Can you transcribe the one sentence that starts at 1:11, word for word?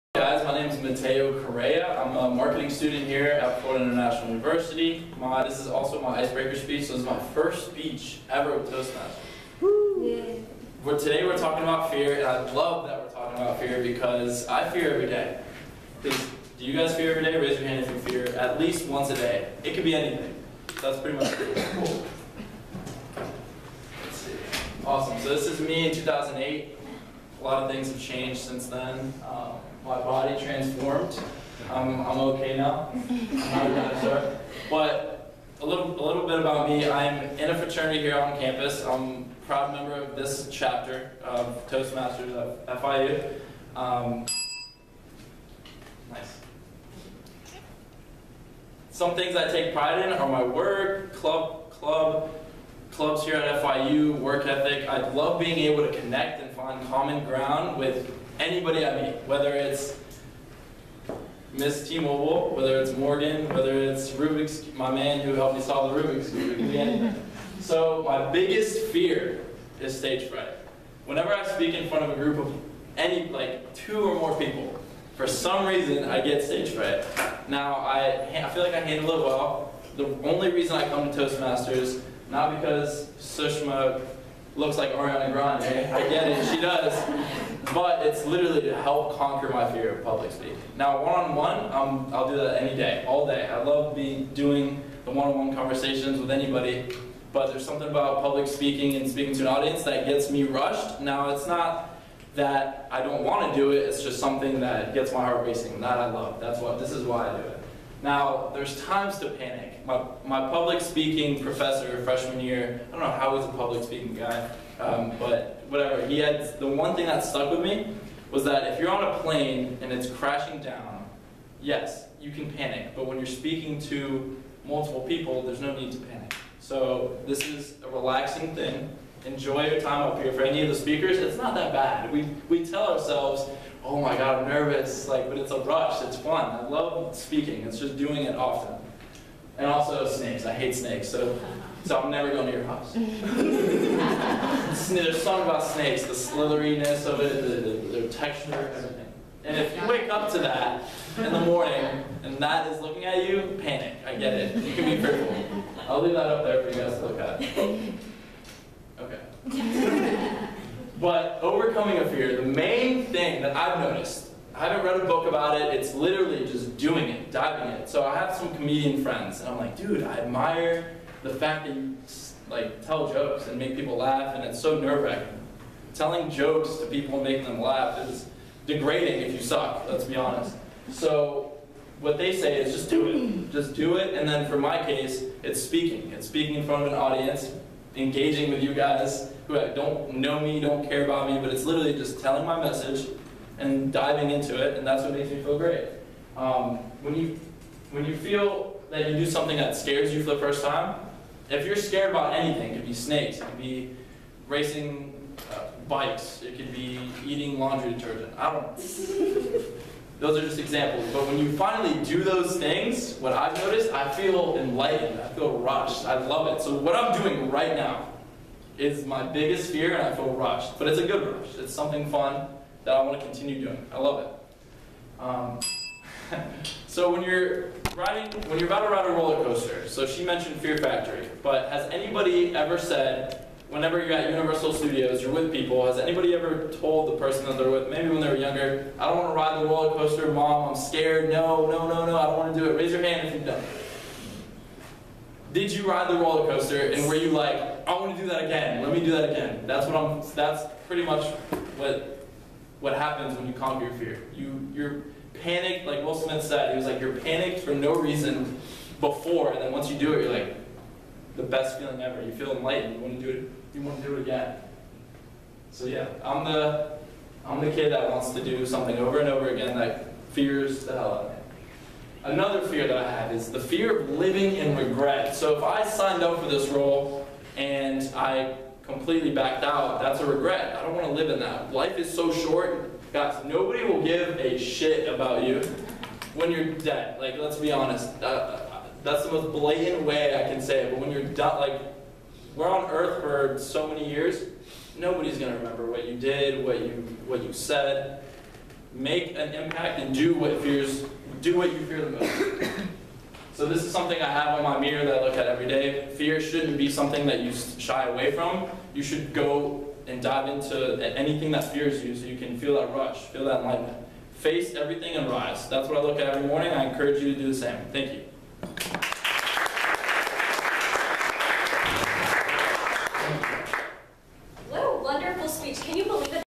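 Whenever I speak in front of a group of any, like two or more people, for some reason I get stage fright.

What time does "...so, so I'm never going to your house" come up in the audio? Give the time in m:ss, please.
2:21.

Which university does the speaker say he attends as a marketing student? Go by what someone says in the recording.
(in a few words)
Florida International University.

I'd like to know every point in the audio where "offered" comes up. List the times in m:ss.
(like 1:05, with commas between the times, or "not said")
not said.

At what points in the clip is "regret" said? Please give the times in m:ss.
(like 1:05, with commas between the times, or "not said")
4:34, 4:40.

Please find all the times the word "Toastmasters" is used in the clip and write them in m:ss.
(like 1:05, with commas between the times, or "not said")
0:08, 0:41, 1:21.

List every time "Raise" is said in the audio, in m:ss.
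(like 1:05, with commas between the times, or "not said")
0:17, 4:02.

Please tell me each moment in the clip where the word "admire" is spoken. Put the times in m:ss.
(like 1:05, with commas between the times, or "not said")
2:50.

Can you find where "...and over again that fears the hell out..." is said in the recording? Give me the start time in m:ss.
4:29.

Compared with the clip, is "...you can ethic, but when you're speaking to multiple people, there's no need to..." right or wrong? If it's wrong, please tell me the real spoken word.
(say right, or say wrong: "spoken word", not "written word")
wrong: "panic", not "ethic".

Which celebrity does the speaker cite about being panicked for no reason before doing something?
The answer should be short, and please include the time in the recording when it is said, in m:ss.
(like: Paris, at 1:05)
Will Smith, at 4:16.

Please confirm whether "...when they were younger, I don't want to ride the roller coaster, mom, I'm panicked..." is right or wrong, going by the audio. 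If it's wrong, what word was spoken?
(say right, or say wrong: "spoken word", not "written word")
wrong: "scared", not "panicked".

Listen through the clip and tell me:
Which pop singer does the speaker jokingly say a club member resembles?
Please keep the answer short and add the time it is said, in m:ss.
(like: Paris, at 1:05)
Ariana Grande, at 1:24.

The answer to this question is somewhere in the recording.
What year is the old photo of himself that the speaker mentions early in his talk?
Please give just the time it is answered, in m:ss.
0:25.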